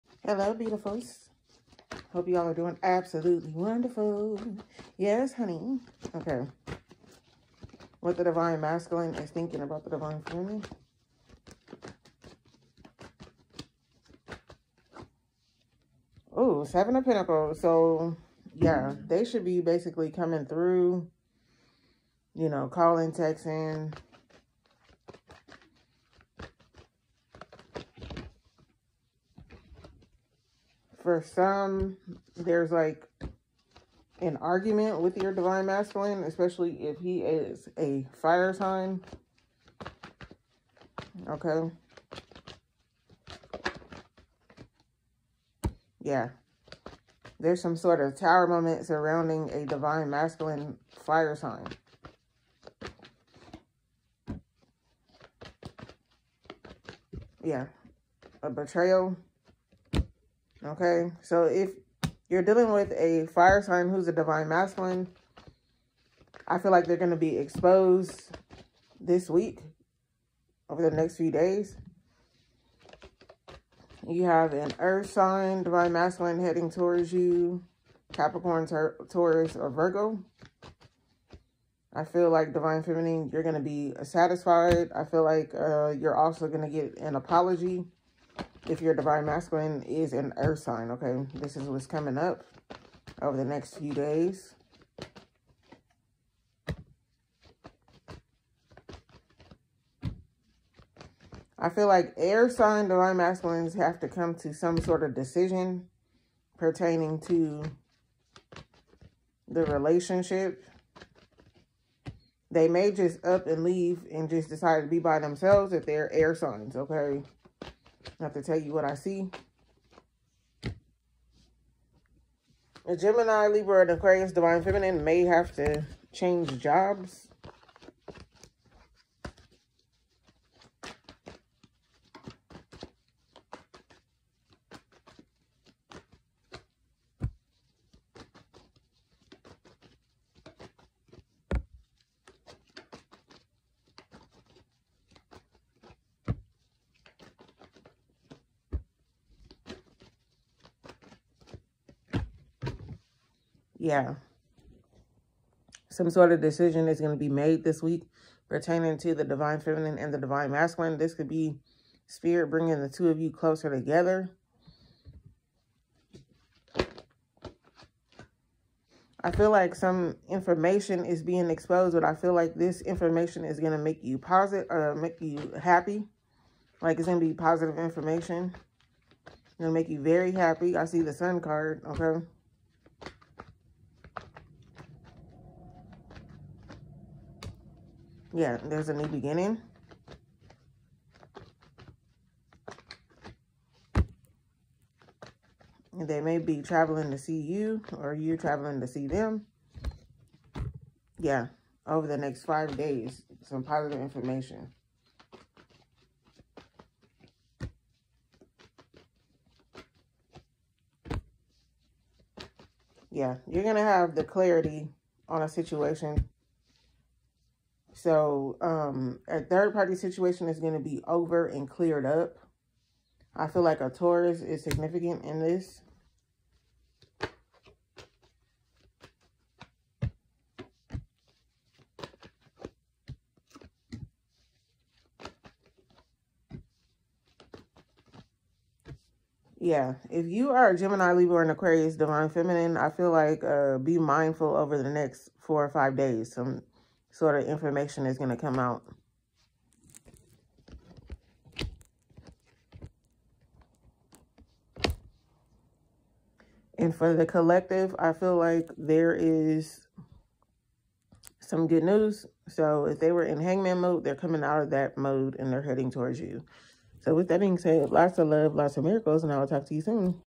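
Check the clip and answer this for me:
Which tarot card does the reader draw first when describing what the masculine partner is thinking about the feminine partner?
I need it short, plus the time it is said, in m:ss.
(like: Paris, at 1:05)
Seven of Pentacles, at 0:16.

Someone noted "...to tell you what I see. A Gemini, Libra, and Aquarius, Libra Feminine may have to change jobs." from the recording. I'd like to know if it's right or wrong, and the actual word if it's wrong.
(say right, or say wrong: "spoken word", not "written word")
wrong: "Divine", not "Libra".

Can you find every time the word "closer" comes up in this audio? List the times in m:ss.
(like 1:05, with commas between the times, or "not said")
2:43.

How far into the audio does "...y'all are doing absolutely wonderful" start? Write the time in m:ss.
0:02.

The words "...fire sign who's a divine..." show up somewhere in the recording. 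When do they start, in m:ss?
1:03.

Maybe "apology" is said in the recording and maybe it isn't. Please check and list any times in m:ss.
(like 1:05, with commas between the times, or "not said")
1:27.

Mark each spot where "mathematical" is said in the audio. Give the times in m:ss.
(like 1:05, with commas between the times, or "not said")
not said.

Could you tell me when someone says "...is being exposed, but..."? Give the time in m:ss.
2:51.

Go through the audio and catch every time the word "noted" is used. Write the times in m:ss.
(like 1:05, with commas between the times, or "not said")
not said.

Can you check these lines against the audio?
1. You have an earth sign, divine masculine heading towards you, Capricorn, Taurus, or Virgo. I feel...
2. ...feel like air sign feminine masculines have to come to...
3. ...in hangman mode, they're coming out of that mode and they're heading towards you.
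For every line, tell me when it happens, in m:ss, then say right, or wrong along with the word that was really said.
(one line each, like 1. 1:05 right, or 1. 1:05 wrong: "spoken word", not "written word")
1. 1:14 right
2. 1:41 wrong: "divine", not "feminine"
3. 4:23 right.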